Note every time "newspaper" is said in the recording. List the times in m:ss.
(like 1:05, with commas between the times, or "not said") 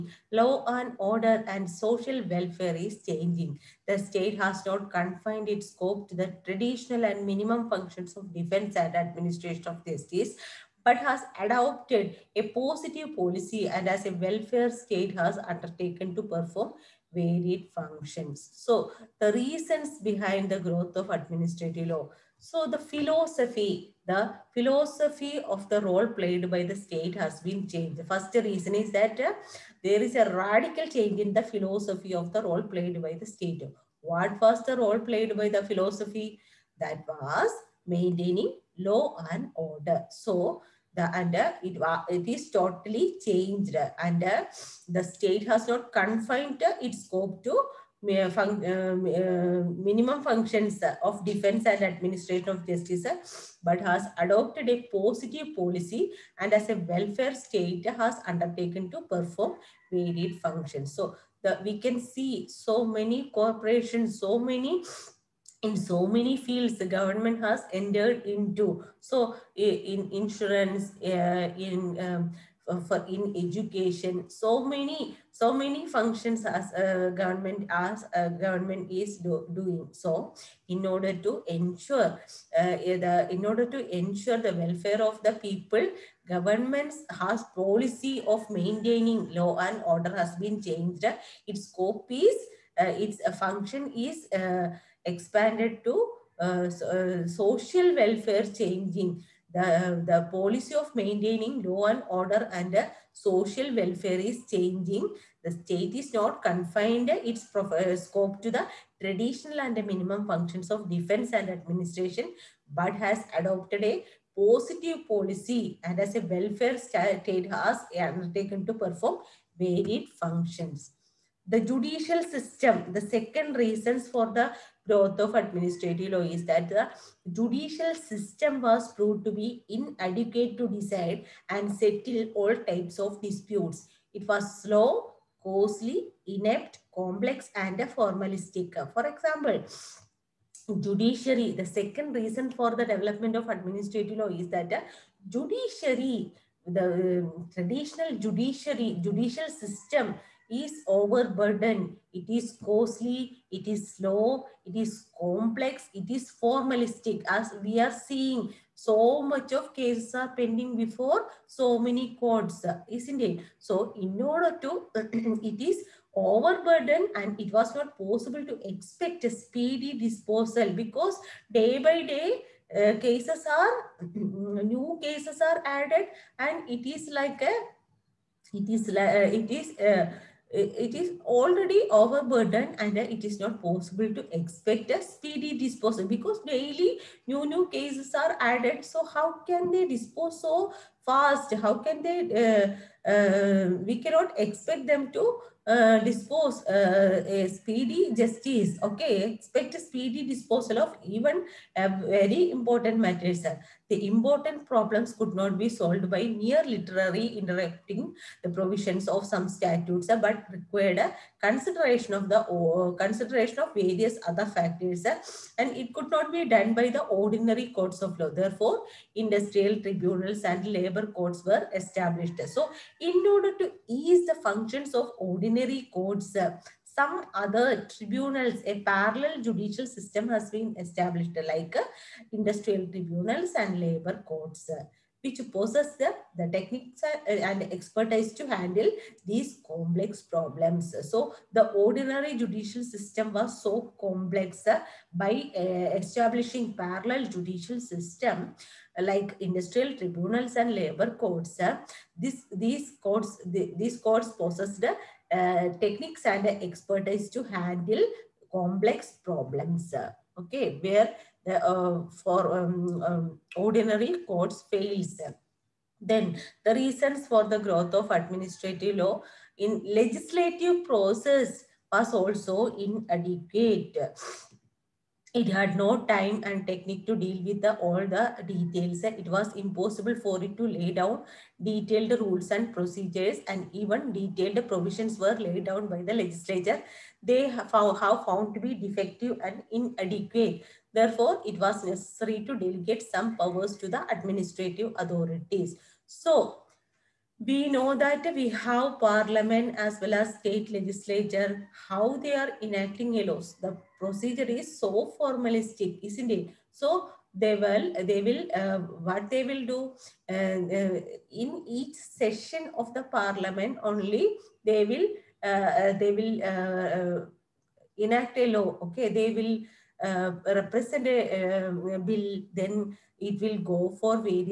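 not said.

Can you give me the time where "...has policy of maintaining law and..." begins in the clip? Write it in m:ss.
1:27.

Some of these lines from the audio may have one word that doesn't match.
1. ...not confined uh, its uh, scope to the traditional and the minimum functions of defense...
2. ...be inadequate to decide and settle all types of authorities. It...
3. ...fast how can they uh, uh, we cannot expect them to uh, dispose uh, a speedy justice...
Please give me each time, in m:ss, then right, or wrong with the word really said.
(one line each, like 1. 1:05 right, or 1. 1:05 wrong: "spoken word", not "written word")
1. 1:46 right
2. 2:09 wrong: "disputes", not "authorities"
3. 3:11 right.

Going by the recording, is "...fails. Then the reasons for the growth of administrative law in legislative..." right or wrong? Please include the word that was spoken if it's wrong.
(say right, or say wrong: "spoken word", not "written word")
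right.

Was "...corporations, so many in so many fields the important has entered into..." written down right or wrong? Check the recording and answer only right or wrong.
wrong.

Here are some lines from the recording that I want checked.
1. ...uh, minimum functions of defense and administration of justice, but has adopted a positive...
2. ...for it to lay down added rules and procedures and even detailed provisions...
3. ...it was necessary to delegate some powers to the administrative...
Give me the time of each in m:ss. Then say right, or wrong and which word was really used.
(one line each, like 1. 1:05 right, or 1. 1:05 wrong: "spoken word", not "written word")
1. 0:48 right
2. 4:40 wrong: "detailed", not "added"
3. 4:51 right.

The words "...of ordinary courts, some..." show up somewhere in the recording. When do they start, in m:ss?
3:44.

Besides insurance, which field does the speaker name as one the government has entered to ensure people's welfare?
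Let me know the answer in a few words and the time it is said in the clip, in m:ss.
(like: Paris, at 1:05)
Education, at 1:13.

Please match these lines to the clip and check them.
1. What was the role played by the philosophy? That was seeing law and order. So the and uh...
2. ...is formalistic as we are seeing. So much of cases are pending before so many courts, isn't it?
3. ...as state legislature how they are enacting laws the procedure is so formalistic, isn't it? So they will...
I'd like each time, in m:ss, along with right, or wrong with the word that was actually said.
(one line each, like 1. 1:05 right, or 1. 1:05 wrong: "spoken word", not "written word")
1. 0:33 wrong: "maintaining", not "seeing"
2. 2:36 right
3. 5:00 right.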